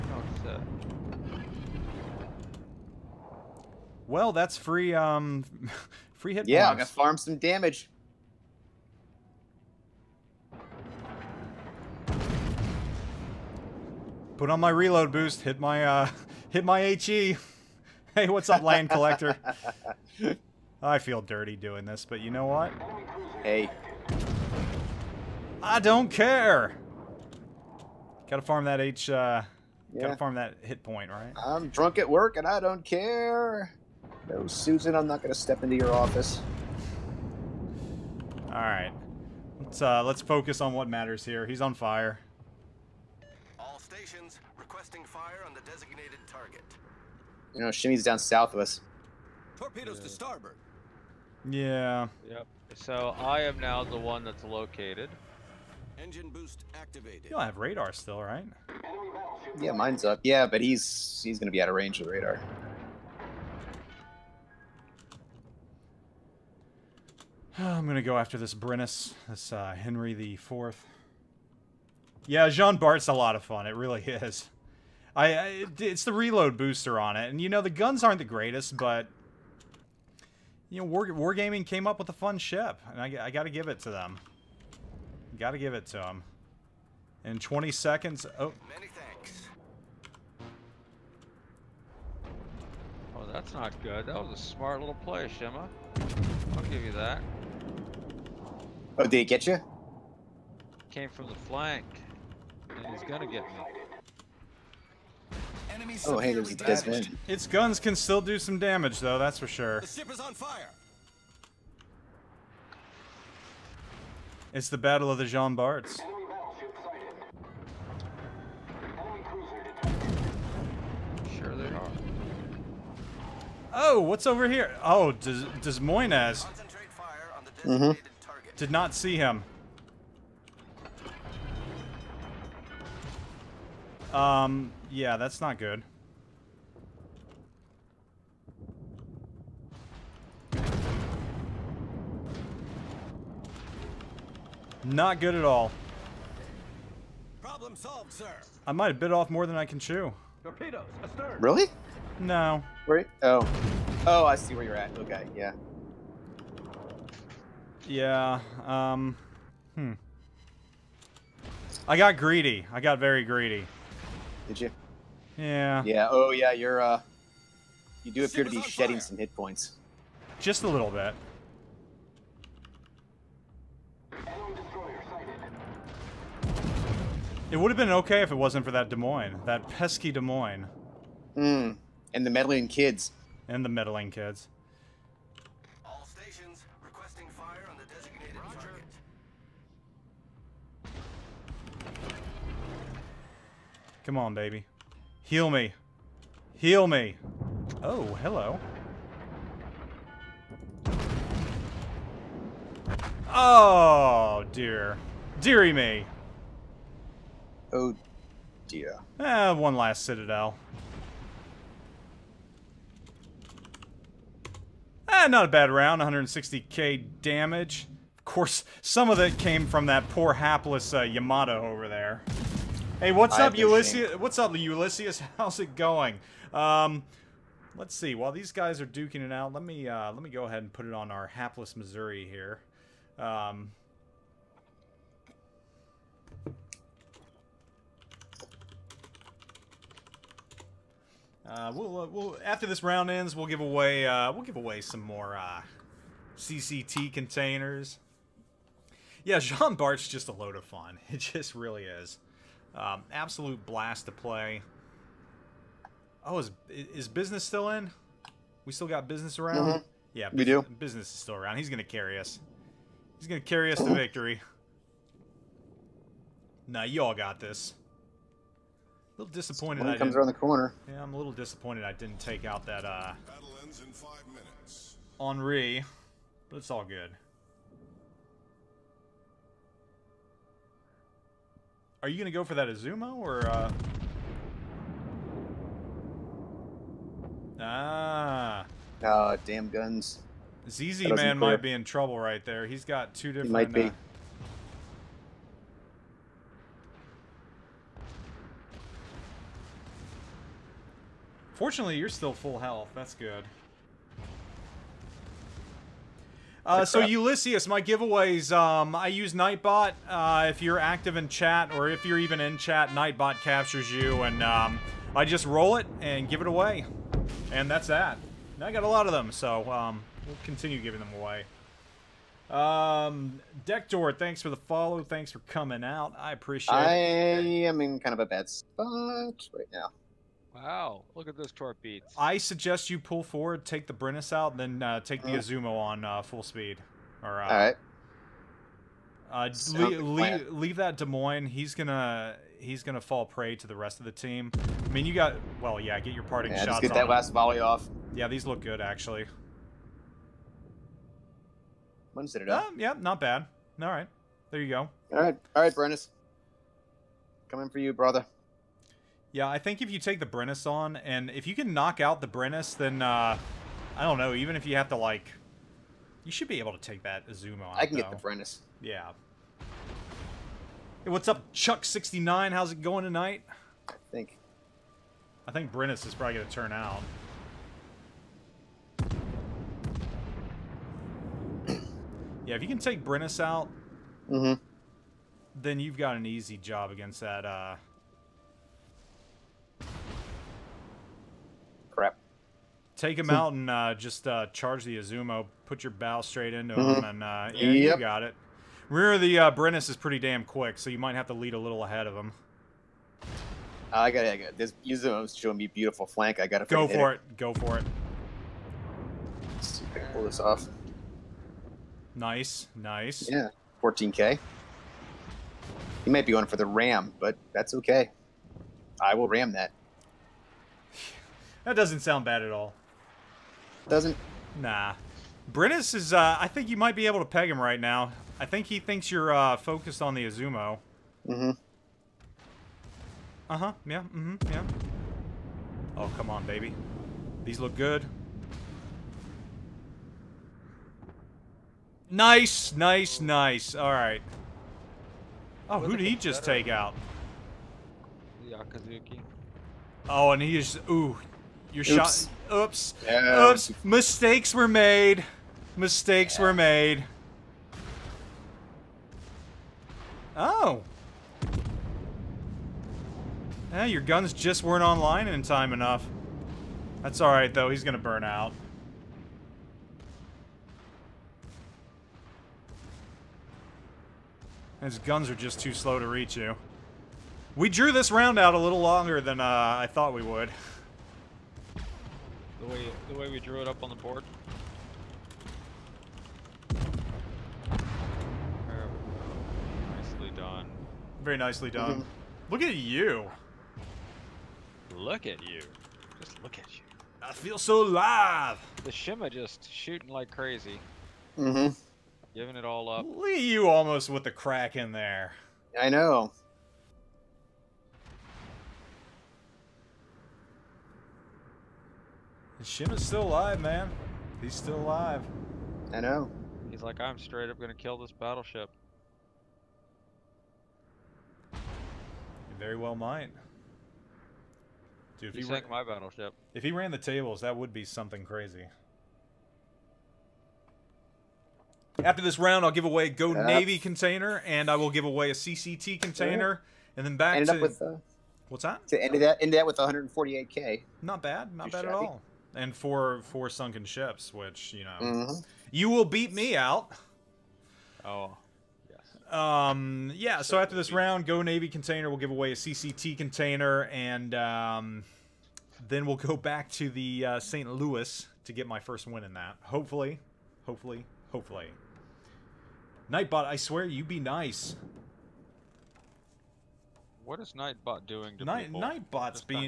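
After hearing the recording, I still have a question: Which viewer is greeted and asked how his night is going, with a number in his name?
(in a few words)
Chuck69.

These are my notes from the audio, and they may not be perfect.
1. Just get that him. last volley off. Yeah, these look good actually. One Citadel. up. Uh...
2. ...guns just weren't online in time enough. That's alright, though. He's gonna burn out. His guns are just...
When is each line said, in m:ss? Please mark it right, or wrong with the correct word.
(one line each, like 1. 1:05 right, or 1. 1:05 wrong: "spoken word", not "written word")
1. 5:46 right
2. 7:44 right.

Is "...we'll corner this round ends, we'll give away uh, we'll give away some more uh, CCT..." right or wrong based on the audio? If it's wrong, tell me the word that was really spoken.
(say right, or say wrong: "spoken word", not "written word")
wrong: "after", not "corner".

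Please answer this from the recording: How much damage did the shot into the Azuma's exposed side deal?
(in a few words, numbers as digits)
14k.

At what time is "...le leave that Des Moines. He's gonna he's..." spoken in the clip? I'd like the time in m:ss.
5:39.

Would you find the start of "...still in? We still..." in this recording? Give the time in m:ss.
4:17.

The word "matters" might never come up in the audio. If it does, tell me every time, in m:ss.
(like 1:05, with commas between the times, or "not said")
0:40.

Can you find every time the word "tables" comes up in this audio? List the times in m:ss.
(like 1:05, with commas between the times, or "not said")
8:46.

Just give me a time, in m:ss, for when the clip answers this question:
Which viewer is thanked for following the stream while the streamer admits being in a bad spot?
5:23.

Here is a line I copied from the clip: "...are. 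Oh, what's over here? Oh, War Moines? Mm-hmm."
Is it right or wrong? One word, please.
wrong.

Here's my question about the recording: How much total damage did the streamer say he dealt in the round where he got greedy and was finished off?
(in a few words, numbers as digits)
160k.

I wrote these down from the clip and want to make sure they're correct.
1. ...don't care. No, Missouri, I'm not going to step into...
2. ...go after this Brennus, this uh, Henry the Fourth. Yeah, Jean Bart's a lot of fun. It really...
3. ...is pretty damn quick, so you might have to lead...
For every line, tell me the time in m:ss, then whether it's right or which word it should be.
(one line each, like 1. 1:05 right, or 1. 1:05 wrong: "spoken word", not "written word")
1. 0:32 wrong: "Susan", not "Missouri"
2. 1:08 right
3. 6:39 right.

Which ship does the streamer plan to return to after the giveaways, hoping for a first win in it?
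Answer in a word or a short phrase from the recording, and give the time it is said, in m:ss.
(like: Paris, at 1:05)
St. Louis, at 9:17.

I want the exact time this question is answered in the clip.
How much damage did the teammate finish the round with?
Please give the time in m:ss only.
8:59.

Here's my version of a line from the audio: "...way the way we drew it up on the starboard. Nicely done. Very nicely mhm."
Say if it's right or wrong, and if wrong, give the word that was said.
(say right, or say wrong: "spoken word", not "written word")
wrong: "board", not "starboard".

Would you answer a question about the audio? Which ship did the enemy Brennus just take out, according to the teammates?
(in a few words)
Yakazuki.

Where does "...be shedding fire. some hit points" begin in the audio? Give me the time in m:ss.
2:48.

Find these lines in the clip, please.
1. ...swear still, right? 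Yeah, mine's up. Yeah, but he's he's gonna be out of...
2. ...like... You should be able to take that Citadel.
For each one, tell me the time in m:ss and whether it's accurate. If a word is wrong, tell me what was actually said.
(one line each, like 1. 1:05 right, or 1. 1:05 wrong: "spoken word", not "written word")
1. 0:57 wrong: "radar", not "swear"
2. 6:04 wrong: "Azumo", not "Citadel".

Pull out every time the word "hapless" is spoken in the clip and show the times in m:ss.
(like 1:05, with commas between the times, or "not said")
3:40, 3:51.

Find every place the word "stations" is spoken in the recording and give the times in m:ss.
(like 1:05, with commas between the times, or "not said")
0:43, 3:06.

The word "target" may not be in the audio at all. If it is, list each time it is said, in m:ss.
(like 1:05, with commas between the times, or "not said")
0:46, 3:11.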